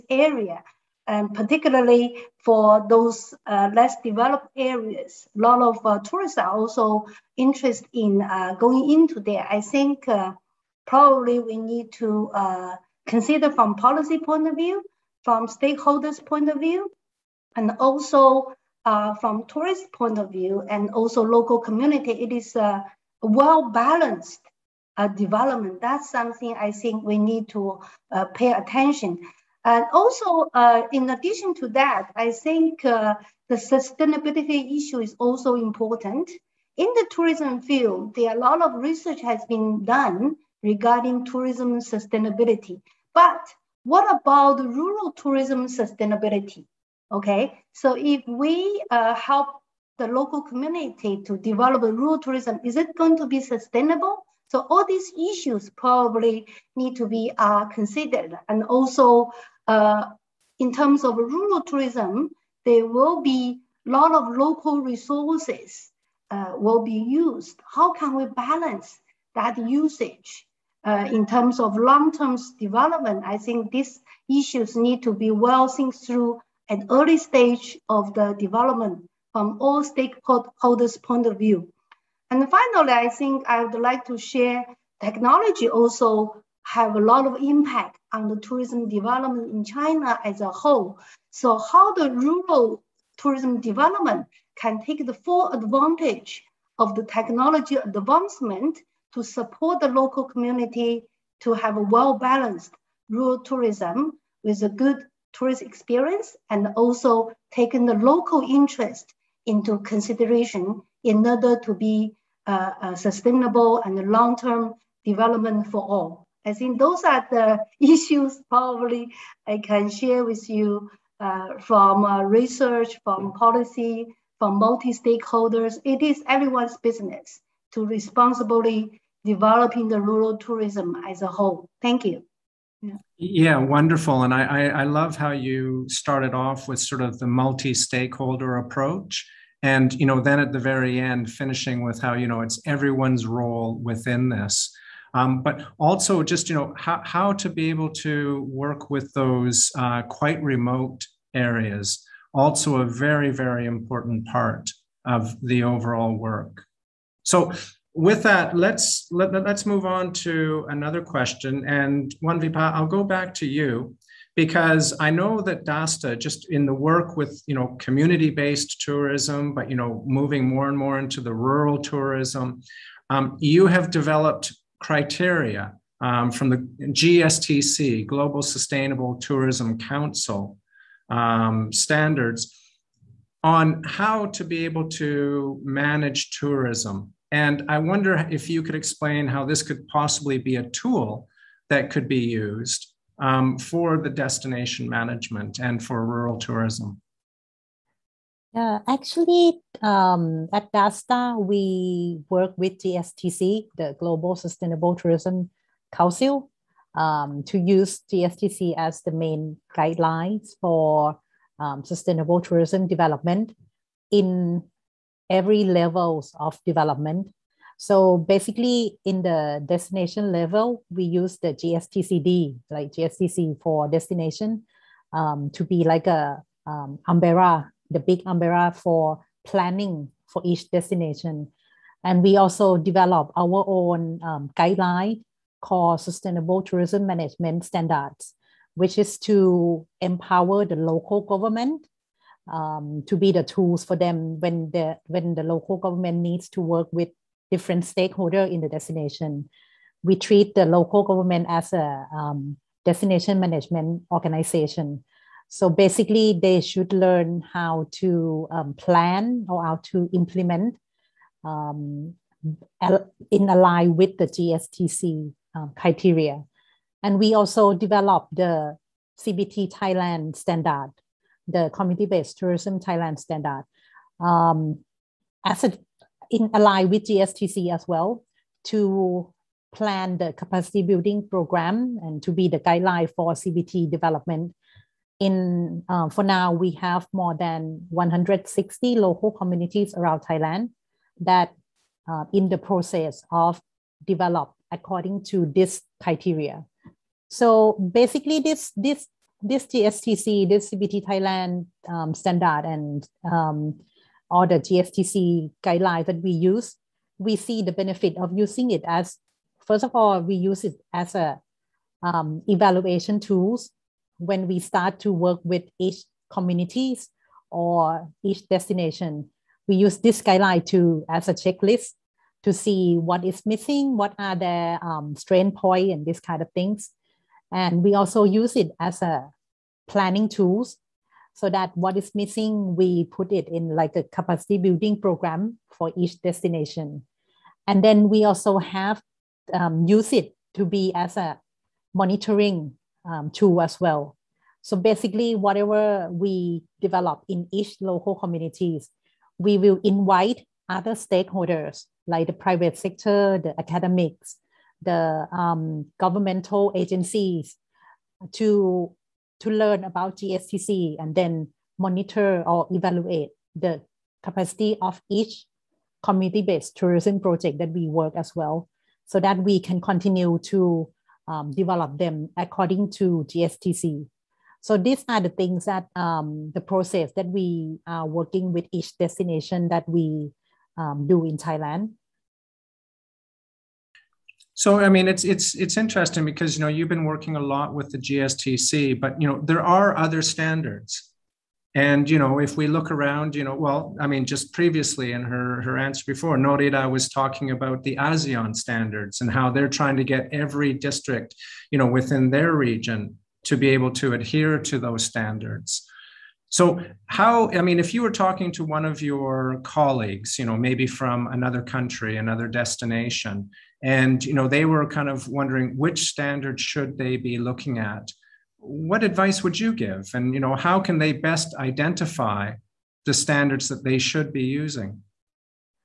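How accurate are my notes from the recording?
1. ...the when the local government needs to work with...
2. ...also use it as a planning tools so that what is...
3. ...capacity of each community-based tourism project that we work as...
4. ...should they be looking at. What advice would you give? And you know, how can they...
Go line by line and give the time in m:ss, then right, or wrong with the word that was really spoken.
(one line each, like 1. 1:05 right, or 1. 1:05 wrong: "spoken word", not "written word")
1. 4:04 right
2. 5:27 right
3. 6:04 right
4. 6:56 right.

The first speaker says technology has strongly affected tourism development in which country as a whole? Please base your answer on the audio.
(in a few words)
China.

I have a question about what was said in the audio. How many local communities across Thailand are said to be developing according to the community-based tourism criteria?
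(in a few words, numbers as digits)
more than 160.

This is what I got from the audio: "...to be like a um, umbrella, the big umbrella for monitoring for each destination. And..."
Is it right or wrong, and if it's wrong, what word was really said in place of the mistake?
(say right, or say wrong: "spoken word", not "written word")
wrong: "planning", not "monitoring".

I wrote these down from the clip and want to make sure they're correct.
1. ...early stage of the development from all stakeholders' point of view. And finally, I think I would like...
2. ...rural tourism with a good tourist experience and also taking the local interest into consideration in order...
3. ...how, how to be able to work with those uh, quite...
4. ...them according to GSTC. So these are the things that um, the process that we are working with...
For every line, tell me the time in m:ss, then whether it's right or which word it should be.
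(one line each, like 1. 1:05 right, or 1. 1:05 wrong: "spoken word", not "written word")
1. 1:16 right
2. 1:43 right
3. 2:26 right
4. 6:11 right.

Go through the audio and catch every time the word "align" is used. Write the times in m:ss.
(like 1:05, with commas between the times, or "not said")
4:23, 4:36.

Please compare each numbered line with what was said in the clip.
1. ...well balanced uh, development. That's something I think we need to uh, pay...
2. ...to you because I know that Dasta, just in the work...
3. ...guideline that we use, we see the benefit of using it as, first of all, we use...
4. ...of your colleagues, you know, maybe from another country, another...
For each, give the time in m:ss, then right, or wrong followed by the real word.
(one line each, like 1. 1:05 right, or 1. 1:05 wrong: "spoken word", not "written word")
1. 0:23 right
2. 2:43 right
3. 5:05 right
4. 6:48 right.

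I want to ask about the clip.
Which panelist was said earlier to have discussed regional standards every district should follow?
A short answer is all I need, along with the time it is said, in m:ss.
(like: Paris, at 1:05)
Norida, at 6:36.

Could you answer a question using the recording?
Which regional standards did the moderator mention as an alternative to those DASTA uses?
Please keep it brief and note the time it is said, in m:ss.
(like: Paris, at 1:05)
ASEAN standards, at 6:37.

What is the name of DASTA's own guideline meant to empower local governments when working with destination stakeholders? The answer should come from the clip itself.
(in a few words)
Sustainable Tourism Management Standards.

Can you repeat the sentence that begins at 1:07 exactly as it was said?
How can we balance that usage uh, in terms of long-term development?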